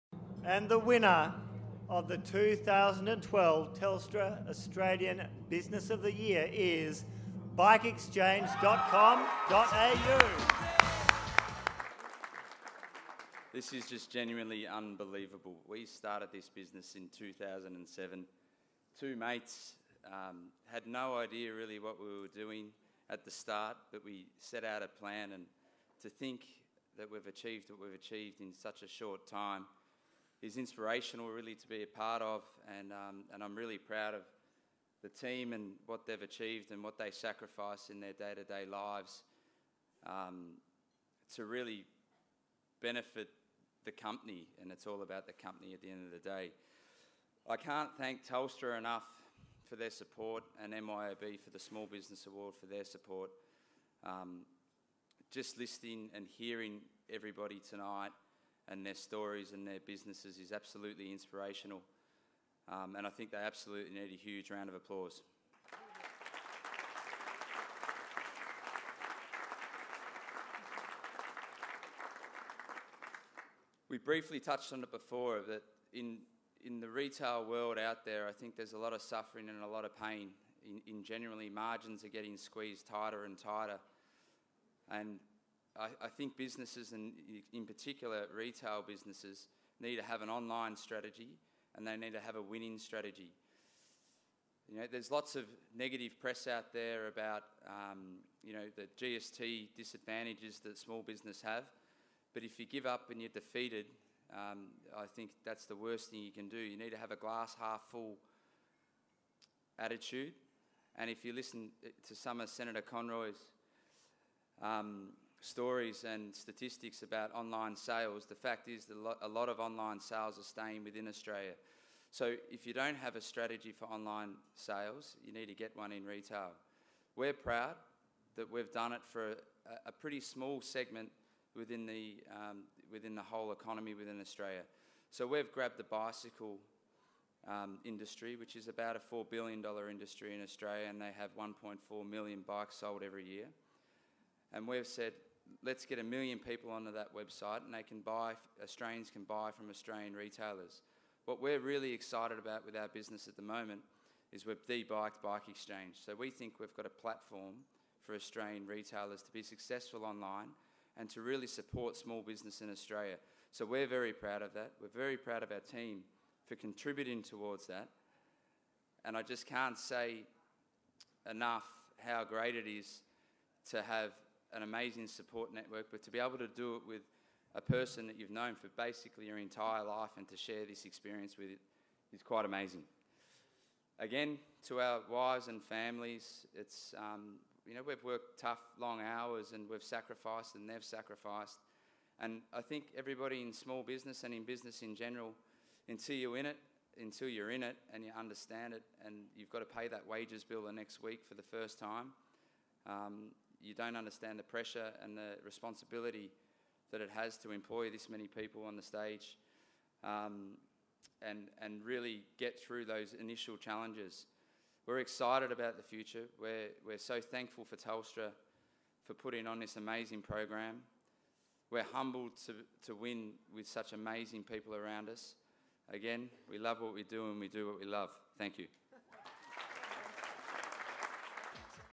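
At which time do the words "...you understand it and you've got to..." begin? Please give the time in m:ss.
3:18.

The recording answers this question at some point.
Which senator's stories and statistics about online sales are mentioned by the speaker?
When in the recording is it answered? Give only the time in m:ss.
1:52.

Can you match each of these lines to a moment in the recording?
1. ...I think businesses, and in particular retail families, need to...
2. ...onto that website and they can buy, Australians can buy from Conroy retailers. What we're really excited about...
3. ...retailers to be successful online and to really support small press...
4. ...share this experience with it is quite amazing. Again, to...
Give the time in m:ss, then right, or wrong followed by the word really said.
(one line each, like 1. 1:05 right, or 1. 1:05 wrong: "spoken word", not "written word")
1. 1:26 wrong: "businesses", not "families"
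2. 2:26 wrong: "Australian", not "Conroy"
3. 2:38 wrong: "business", not "press"
4. 3:00 right.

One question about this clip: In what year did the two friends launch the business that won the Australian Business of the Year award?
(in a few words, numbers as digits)
2007.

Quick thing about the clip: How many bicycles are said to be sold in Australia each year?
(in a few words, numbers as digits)
1.4 million.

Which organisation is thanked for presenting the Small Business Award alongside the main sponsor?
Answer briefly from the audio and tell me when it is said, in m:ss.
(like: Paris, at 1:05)
MYOB, at 0:50.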